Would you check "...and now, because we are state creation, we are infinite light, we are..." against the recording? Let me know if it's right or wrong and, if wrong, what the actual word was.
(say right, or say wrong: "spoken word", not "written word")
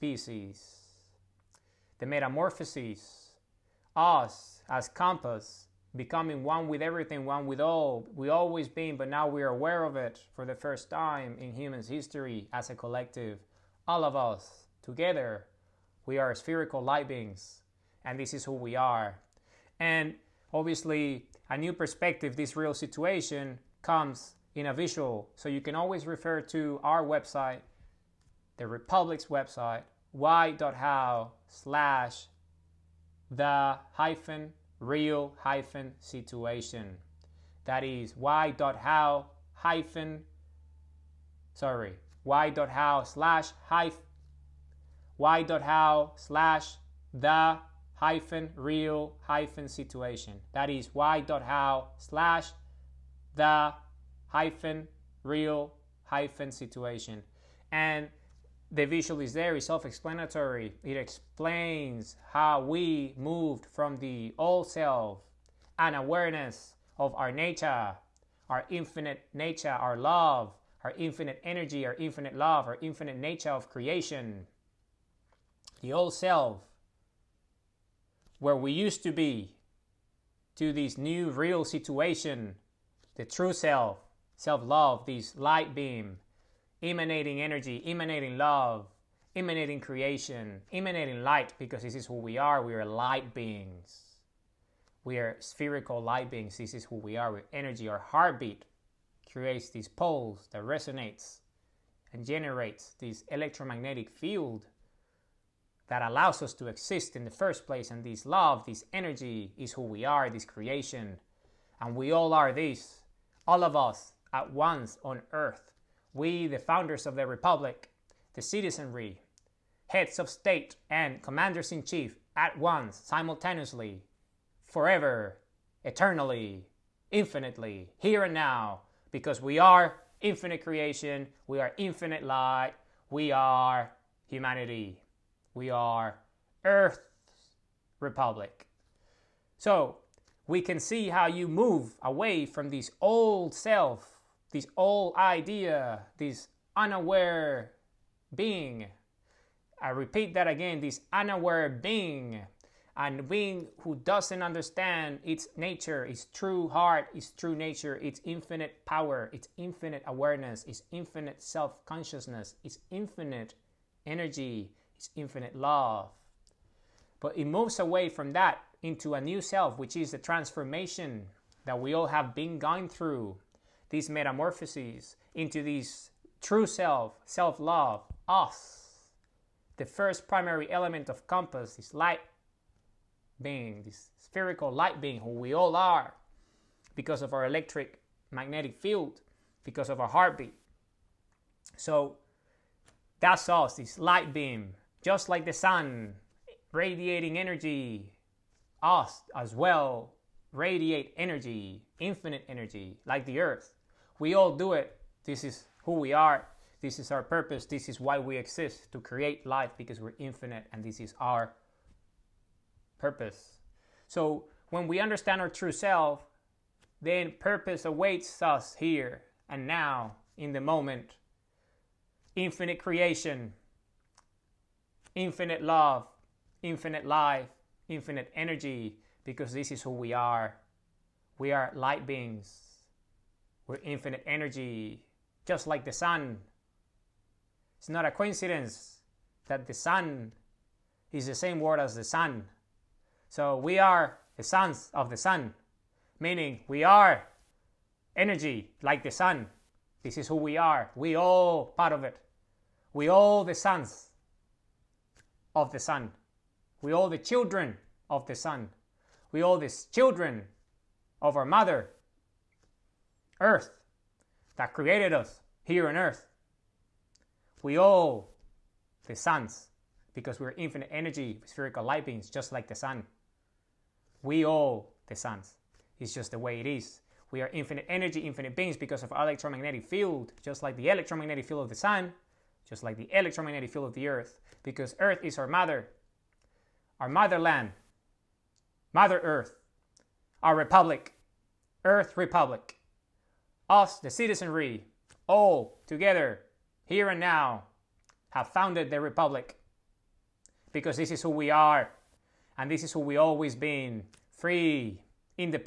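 wrong: "infinite", not "state".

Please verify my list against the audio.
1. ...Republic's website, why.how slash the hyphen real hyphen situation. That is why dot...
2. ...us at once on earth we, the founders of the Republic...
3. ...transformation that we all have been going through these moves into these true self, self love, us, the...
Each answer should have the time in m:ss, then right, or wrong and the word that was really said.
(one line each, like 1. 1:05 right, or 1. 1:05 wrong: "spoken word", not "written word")
1. 0:28 right
2. 1:53 right
3. 2:50 wrong: "metamorphoses", not "moves".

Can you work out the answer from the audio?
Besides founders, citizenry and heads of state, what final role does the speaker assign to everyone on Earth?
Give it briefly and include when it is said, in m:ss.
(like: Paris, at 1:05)
Commanders in chief, at 2:01.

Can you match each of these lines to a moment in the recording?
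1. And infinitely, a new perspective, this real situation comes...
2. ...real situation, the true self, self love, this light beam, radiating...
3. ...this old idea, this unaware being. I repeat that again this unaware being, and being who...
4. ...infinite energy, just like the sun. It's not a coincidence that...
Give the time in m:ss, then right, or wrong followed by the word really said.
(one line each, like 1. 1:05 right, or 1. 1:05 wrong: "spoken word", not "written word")
1. 0:19 wrong: "obviously", not "infinitely"
2. 1:21 wrong: "emanating", not "radiating"
3. 2:24 right
4. 3:53 right.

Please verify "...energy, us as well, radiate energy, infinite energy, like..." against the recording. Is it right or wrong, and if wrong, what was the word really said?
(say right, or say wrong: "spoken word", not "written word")
right.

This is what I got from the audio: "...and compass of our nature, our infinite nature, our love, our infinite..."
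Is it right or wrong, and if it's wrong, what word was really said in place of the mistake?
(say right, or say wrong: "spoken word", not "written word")
wrong: "awareness", not "compass".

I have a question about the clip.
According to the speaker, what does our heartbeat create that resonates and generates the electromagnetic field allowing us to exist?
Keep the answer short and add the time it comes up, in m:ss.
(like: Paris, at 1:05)
Poles, at 1:39.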